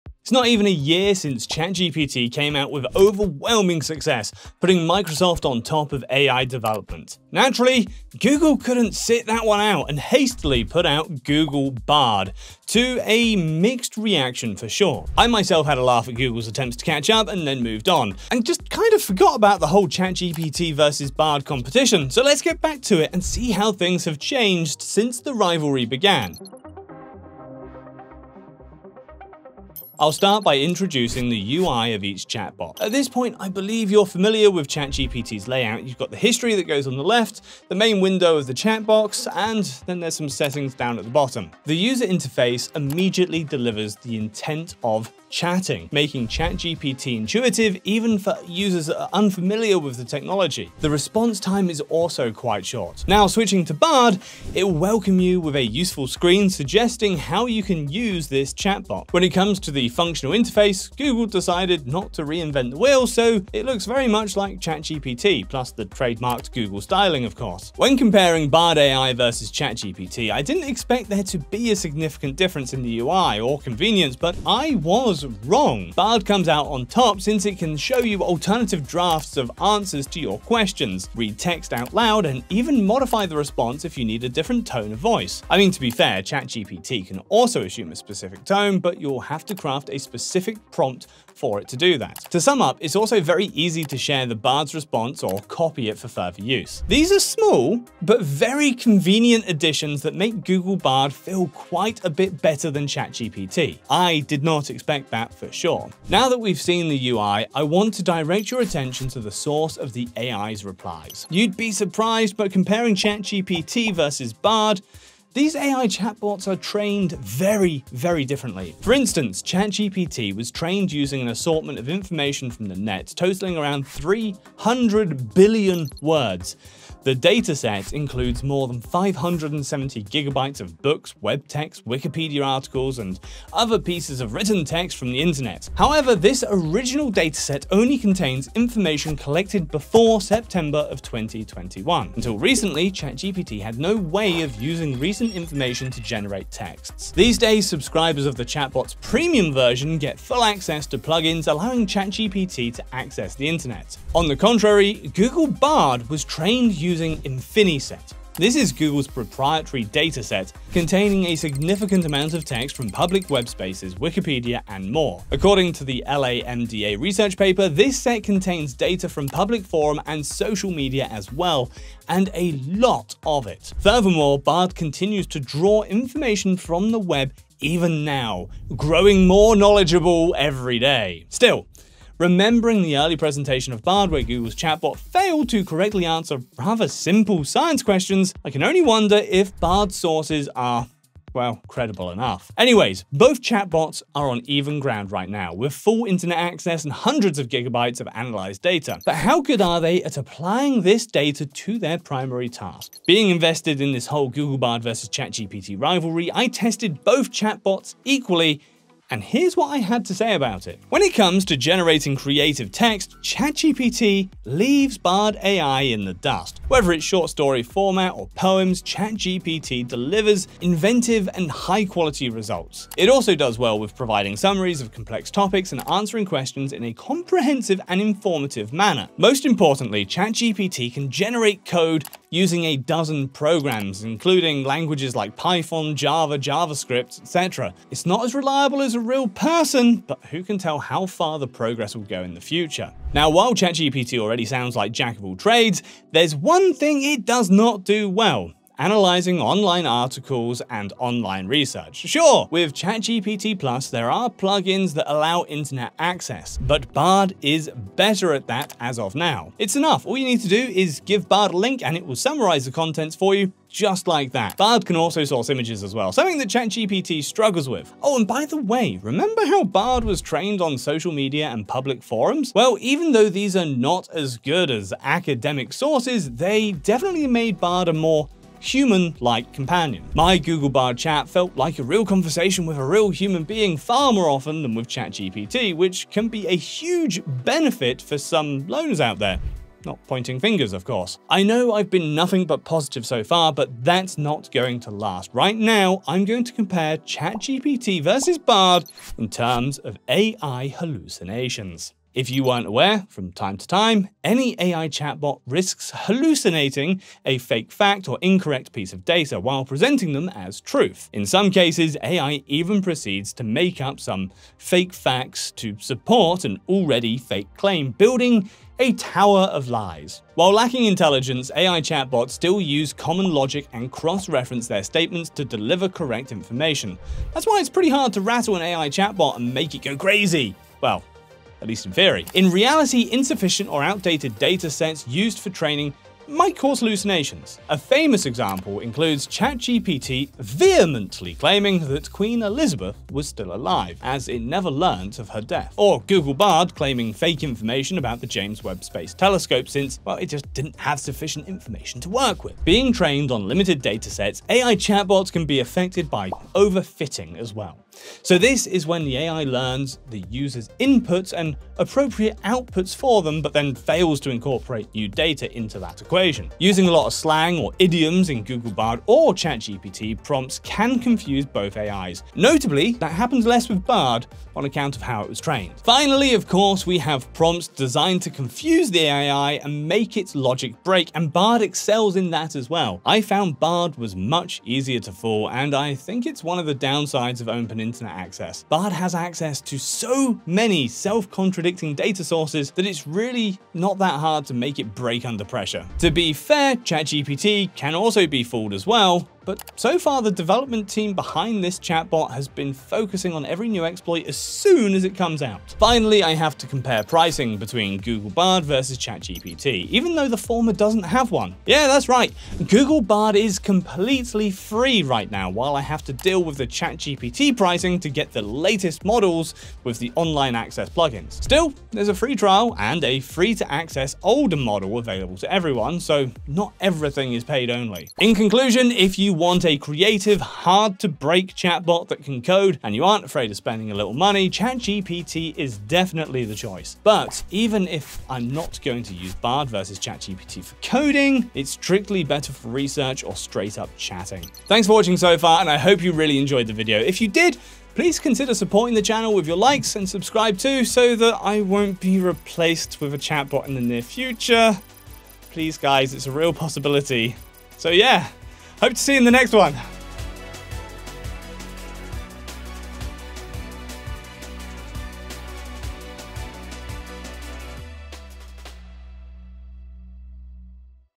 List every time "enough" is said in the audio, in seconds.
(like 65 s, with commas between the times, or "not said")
192 s, 259 s.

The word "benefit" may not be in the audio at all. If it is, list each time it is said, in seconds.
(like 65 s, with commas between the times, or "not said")
287 s.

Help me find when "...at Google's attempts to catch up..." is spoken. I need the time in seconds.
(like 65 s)
16 s.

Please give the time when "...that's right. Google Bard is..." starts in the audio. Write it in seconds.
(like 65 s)
411 s.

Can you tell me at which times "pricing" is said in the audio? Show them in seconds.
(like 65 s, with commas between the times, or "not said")
407 s, 417 s.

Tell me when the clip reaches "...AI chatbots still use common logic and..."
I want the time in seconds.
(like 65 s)
321 s.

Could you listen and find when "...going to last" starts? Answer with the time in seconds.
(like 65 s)
294 s.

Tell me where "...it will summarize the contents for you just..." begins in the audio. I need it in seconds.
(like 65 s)
261 s.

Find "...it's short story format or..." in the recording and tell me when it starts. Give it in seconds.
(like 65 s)
216 s.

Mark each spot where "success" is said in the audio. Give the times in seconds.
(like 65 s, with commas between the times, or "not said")
3 s.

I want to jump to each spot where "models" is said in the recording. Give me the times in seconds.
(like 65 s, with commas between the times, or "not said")
419 s, 424 s.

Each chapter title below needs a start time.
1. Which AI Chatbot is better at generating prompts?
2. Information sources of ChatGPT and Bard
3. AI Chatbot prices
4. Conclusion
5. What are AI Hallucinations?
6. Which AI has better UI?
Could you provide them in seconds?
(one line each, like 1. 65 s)
1. 198 s
2. 104 s
3. 405 s
4. 428 s
5. 291 s
6. 30 s.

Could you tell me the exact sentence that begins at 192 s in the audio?
Anyways, both chatbots are on even ground right now, with full internet access and hundreds of gigabytes of analyzed data.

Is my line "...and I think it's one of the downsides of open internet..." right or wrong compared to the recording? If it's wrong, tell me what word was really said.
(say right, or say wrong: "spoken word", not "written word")
right.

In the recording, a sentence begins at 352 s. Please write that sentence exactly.
Being trained on limited datasets, AI chatbots can be affected by overfitting as well.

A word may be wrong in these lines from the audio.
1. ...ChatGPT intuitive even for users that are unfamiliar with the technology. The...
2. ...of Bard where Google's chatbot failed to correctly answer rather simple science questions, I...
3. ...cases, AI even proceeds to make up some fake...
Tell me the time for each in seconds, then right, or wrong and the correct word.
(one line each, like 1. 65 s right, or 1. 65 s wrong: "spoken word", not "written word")
1. 46 s right
2. 183 s right
3. 311 s right.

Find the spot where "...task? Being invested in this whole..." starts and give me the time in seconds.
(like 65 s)
202 s.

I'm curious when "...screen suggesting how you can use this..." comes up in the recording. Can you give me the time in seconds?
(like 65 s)
56 s.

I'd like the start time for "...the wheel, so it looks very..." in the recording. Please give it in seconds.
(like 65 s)
62 s.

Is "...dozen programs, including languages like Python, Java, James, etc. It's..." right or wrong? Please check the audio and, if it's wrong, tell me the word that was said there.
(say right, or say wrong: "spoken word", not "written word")
wrong: "JavaScript", not "James".